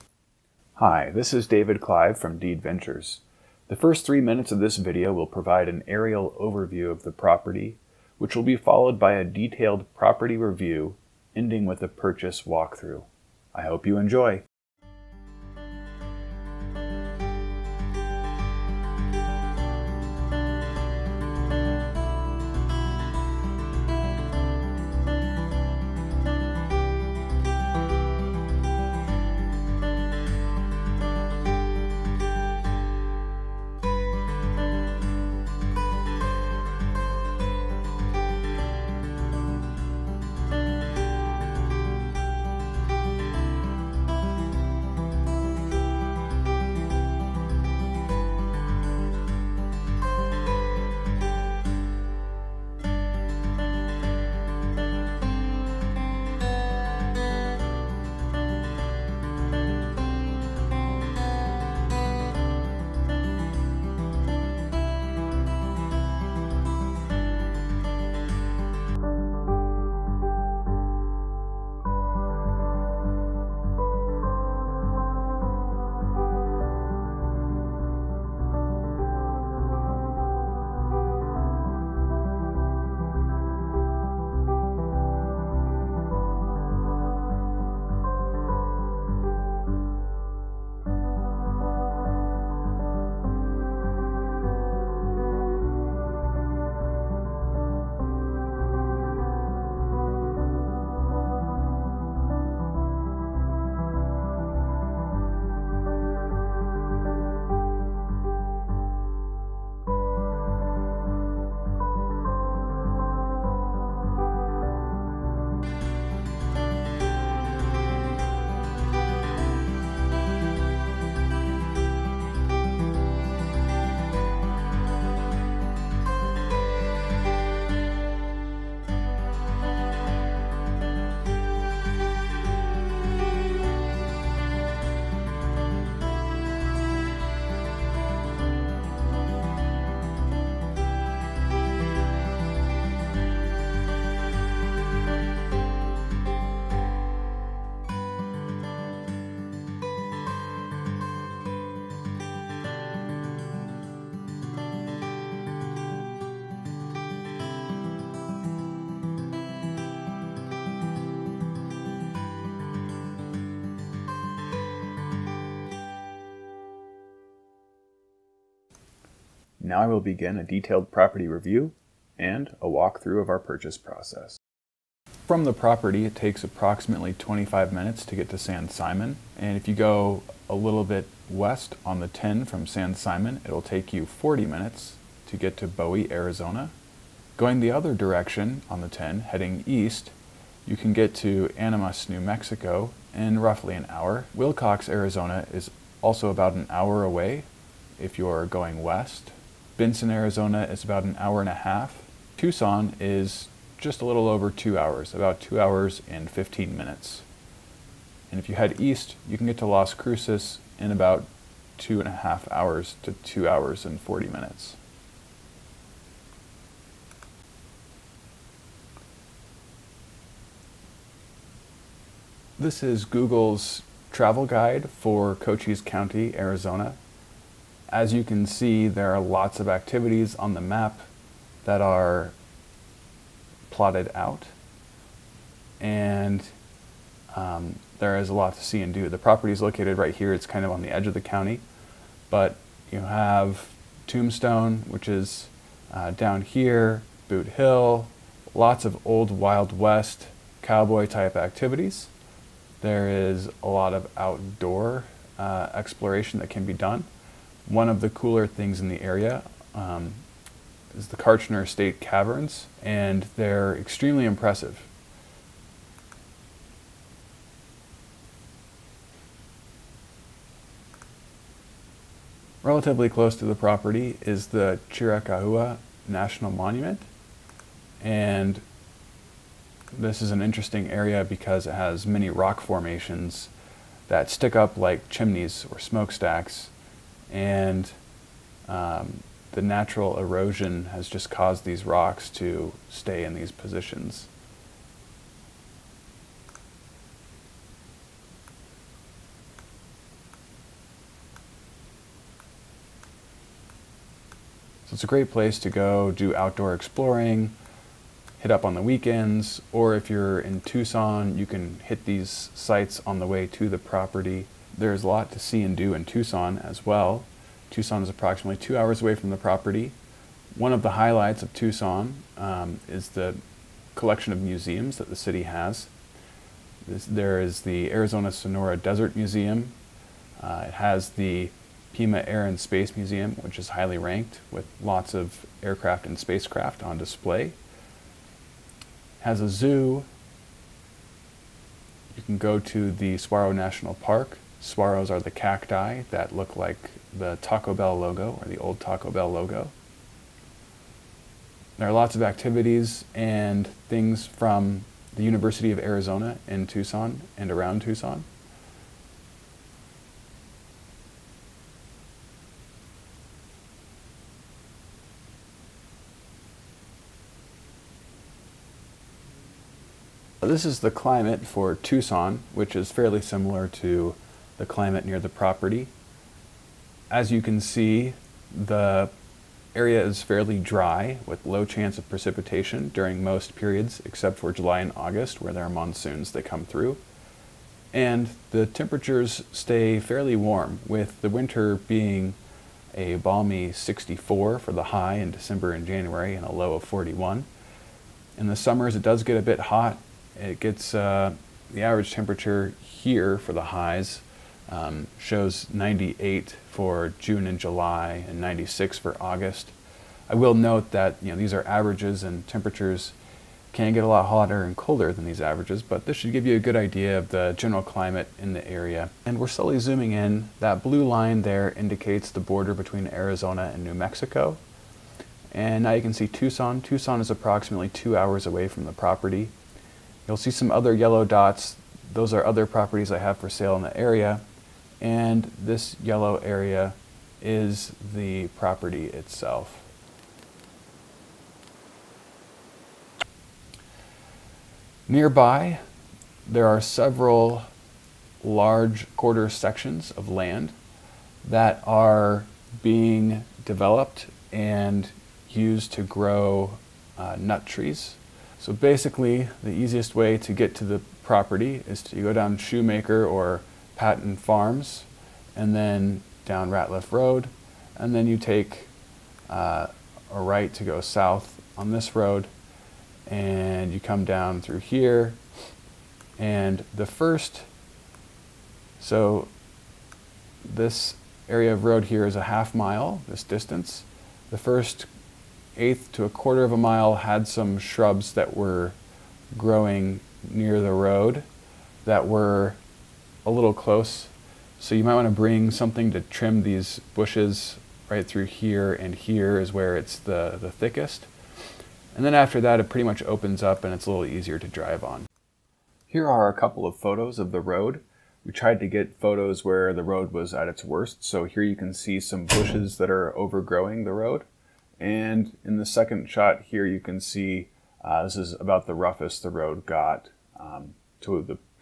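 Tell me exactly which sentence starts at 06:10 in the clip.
This is the climate for Tucson, which is fairly similar to the climate near the property.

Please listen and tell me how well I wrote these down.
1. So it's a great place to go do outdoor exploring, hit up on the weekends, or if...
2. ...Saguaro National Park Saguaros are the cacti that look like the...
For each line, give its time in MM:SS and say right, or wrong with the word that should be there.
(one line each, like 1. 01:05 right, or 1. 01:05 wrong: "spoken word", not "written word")
1. 05:04 right
2. 05:43 right.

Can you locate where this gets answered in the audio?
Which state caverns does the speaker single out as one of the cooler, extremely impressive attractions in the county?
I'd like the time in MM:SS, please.
04:21.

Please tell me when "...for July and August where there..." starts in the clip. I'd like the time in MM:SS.
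06:24.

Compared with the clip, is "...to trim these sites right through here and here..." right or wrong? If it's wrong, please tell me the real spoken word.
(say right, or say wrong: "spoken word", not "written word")
wrong: "bushes", not "sites".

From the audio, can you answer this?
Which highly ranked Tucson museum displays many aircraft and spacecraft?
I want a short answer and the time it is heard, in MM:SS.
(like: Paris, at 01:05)
Pima Air and Space Museum, at 05:31.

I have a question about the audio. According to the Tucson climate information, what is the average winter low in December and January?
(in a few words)
41.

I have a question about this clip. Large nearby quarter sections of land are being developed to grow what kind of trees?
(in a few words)
nut trees.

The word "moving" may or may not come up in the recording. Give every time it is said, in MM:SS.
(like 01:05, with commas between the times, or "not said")
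not said.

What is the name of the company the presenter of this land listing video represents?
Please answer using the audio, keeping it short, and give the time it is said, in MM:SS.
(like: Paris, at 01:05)
Deed Ventures, at 00:02.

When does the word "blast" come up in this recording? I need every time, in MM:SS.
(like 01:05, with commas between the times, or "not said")
not said.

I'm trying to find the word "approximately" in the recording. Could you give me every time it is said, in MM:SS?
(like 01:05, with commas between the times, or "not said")
02:56, 05:18, 07:07.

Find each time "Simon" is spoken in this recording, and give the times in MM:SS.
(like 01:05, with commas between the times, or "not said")
02:58, 03:02.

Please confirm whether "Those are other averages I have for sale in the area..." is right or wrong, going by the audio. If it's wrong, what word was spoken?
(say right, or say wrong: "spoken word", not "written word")
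wrong: "properties", not "averages".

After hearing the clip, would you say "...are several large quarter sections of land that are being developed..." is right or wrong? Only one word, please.
right.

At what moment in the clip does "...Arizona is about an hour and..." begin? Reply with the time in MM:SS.
03:20.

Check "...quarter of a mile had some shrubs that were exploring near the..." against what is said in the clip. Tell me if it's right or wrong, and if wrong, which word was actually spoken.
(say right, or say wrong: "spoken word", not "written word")
wrong: "growing", not "exploring".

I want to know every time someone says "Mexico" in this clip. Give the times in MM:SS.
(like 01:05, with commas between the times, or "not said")
03:12, 07:03.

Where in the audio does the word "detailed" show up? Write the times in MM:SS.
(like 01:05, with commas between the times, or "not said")
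00:09, 02:50.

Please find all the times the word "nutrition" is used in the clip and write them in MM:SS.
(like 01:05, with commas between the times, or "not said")
not said.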